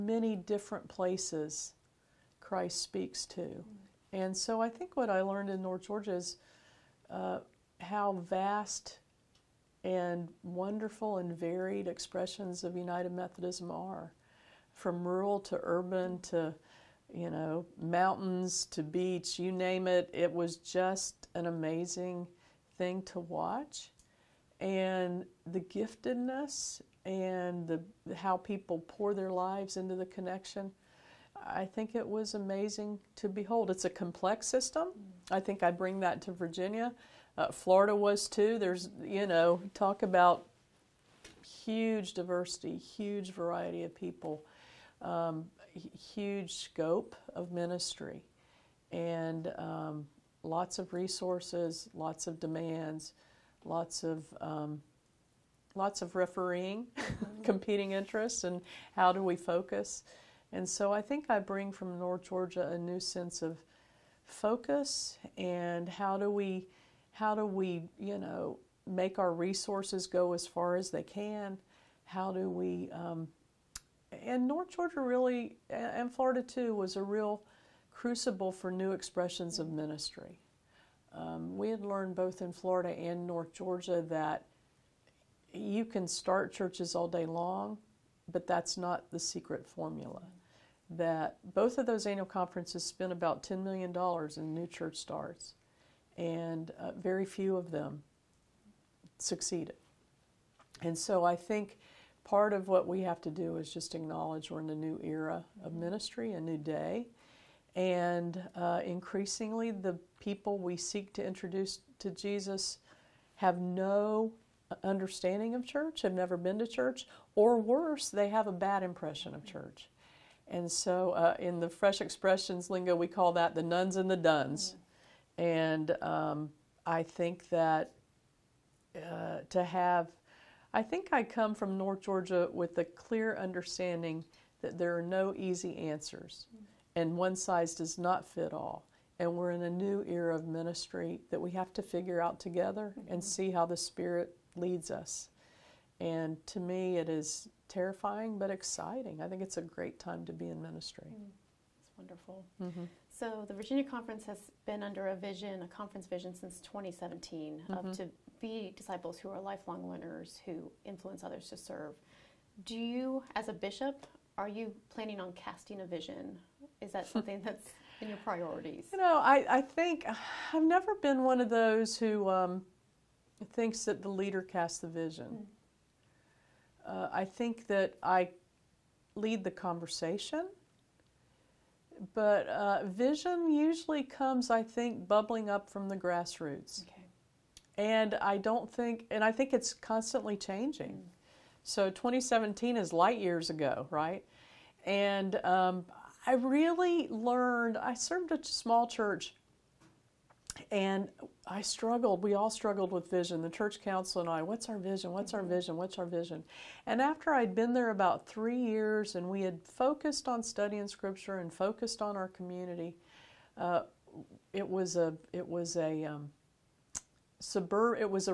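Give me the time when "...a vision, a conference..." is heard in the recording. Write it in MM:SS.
02:35.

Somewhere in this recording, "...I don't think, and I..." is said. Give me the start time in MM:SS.
03:08.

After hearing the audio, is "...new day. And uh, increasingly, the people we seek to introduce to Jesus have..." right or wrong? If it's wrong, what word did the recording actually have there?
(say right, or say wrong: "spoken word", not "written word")
right.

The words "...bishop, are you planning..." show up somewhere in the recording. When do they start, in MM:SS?
02:43.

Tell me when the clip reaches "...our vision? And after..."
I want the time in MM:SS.
03:25.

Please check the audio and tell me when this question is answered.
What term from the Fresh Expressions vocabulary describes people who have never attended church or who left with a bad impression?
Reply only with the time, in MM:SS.
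02:03.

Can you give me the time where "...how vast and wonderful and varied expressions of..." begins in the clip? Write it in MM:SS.
00:07.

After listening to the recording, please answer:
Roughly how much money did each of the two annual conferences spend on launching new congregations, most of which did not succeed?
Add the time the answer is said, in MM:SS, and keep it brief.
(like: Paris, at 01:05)
$10 million, at 01:33.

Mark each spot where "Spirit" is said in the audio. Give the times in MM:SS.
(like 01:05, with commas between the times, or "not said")
02:23.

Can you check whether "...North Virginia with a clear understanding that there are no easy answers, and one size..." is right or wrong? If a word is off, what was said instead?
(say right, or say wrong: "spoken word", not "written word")
wrong: "Georgia", not "Virginia".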